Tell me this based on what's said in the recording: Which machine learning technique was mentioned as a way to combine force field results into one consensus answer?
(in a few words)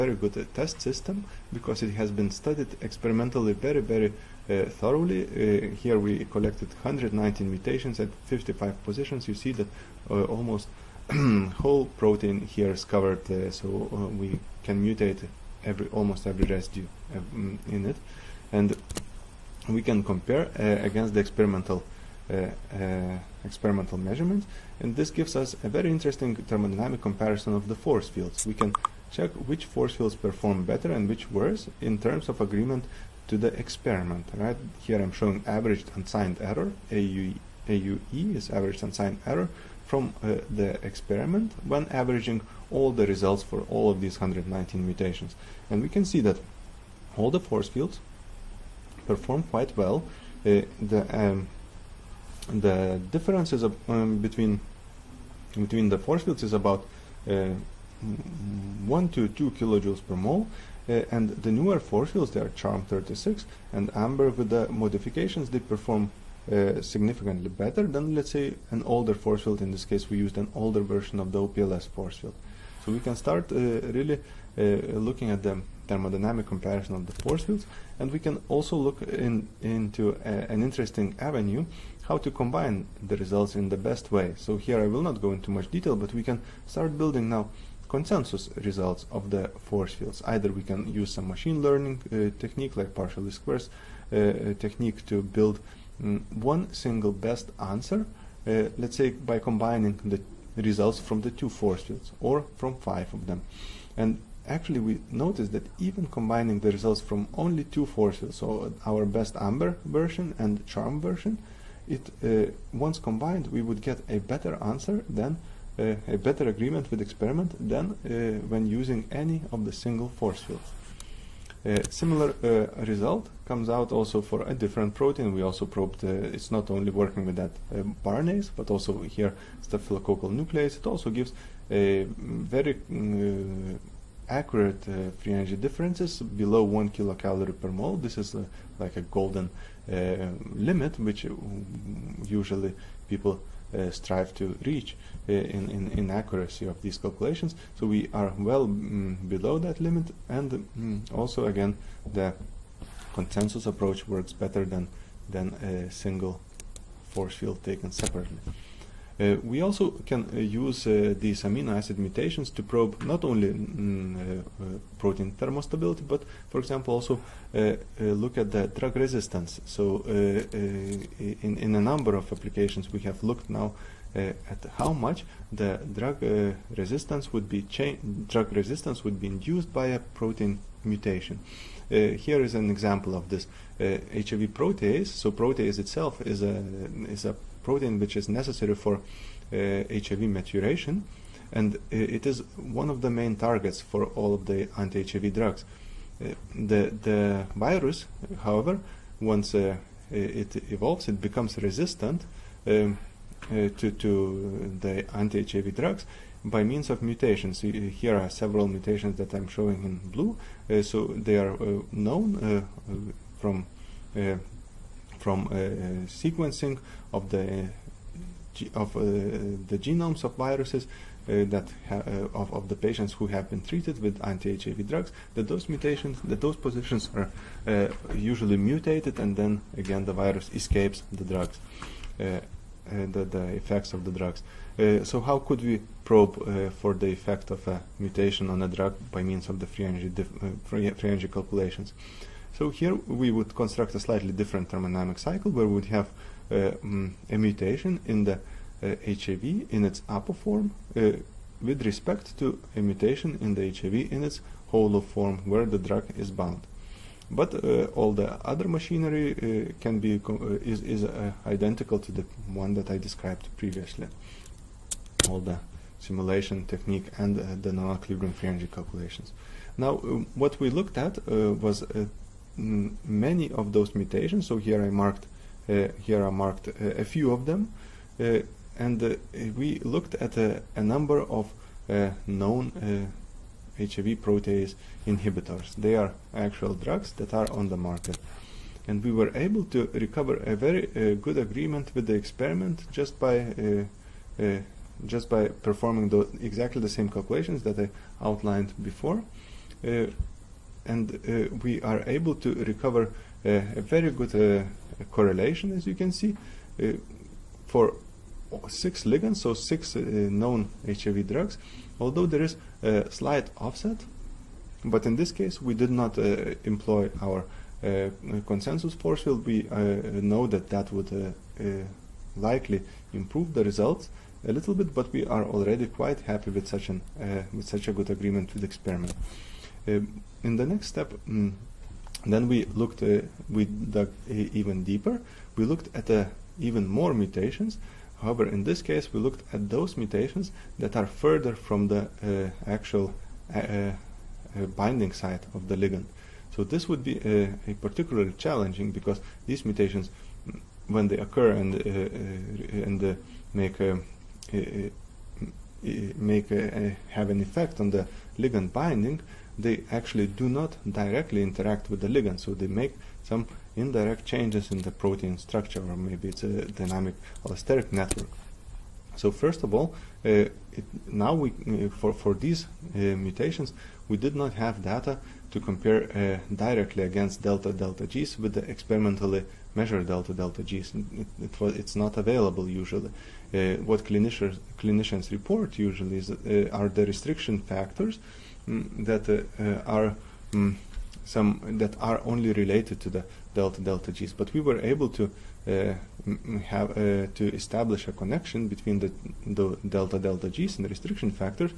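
partial least squares.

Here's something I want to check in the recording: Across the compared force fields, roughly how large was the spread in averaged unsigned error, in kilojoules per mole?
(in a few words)
1 to 2.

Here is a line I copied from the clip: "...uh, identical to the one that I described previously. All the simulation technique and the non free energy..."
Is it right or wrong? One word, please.
right.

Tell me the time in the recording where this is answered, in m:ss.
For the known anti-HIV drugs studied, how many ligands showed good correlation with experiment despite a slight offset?
5:08.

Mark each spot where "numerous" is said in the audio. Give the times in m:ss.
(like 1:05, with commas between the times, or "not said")
not said.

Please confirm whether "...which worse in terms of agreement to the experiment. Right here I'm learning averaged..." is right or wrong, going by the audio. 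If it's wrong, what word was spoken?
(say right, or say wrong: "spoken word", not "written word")
wrong: "showing", not "learning".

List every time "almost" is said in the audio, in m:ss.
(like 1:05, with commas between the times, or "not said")
0:10, 0:15.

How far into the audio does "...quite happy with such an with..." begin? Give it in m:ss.
5:25.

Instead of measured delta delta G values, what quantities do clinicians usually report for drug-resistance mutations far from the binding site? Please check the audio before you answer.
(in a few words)
restriction factors.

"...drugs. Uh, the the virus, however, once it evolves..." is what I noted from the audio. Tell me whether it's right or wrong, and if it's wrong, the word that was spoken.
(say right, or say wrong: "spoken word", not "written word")
right.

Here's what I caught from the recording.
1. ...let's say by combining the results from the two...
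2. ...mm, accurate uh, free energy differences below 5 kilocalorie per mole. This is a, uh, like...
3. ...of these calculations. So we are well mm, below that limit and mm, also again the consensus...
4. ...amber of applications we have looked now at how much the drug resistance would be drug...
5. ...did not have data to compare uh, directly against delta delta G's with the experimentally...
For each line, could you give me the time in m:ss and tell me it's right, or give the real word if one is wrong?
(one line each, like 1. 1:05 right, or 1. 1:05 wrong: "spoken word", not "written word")
1. 1:38 right
2. 2:12 wrong: "1", not "5"
3. 2:26 right
4. 2:51 wrong: "number", not "amber"
5. 6:14 right.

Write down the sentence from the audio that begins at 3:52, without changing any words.
The, the, effects of the drugs.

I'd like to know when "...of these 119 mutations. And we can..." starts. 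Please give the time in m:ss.
0:43.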